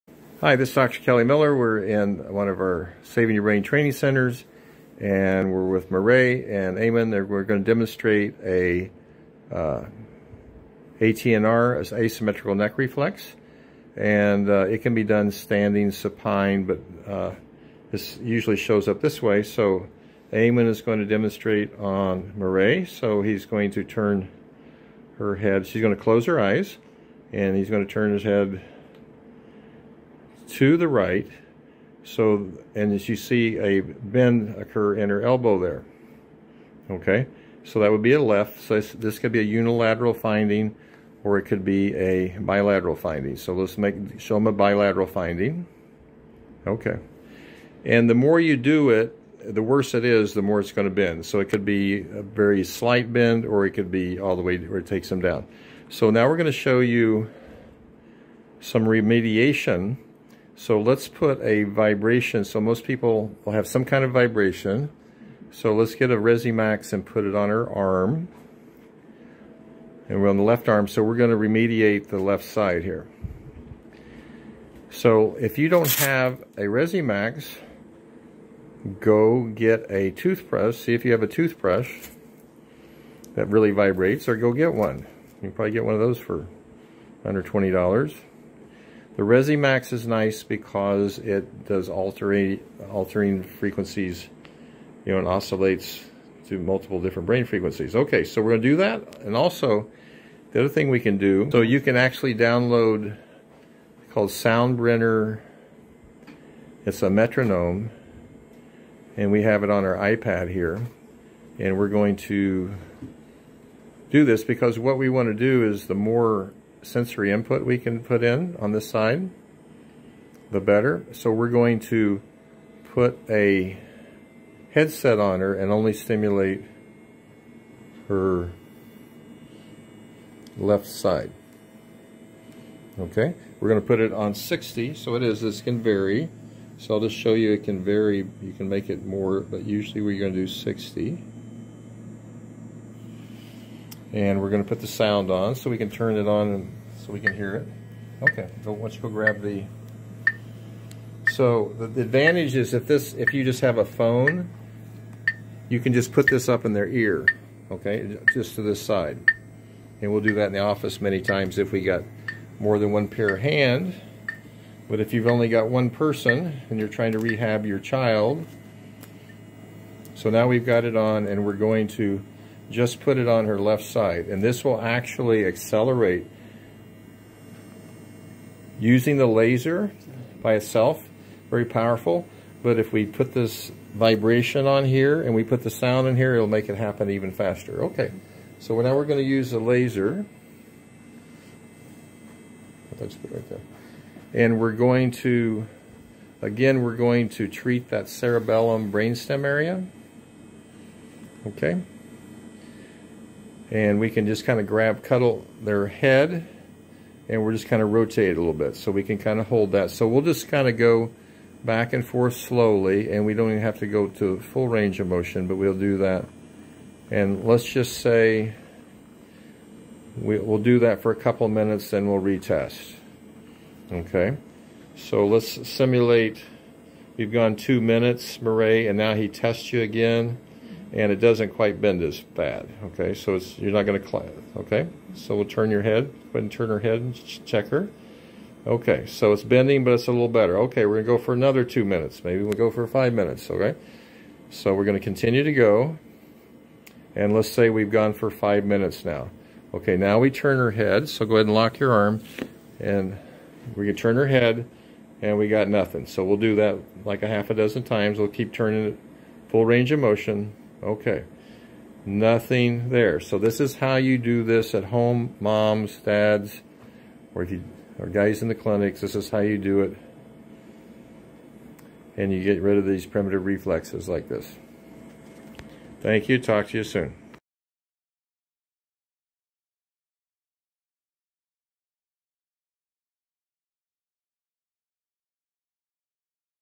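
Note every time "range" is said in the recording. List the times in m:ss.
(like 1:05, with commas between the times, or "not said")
3:34, 4:19.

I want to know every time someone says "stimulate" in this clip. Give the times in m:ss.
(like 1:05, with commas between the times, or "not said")
2:05.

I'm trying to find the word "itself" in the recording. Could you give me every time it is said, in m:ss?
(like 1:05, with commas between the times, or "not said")
3:00.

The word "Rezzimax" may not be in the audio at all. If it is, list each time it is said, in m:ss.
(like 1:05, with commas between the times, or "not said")
1:06, 1:16, 1:29.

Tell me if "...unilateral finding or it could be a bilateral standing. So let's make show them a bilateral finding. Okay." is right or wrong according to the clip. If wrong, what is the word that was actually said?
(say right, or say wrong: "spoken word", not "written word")
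wrong: "finding", not "standing".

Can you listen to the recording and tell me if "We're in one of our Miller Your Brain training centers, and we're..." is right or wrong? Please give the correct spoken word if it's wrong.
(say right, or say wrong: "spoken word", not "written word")
wrong: "Saving", not "Miller".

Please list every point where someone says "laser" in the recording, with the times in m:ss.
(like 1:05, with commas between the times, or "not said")
2:59, 3:09.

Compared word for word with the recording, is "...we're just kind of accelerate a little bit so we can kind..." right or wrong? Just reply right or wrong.
wrong.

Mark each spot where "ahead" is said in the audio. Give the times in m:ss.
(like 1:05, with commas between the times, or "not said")
3:56, 4:11.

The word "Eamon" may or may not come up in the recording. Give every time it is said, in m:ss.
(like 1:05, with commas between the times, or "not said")
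0:06, 0:20.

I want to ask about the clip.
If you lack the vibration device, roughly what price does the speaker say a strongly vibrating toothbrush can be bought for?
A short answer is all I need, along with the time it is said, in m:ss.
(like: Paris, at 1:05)
under $20, at 1:27.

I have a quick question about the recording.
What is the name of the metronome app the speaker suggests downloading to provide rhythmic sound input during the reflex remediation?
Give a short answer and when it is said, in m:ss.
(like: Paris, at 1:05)
Soundbrenner, at 1:44.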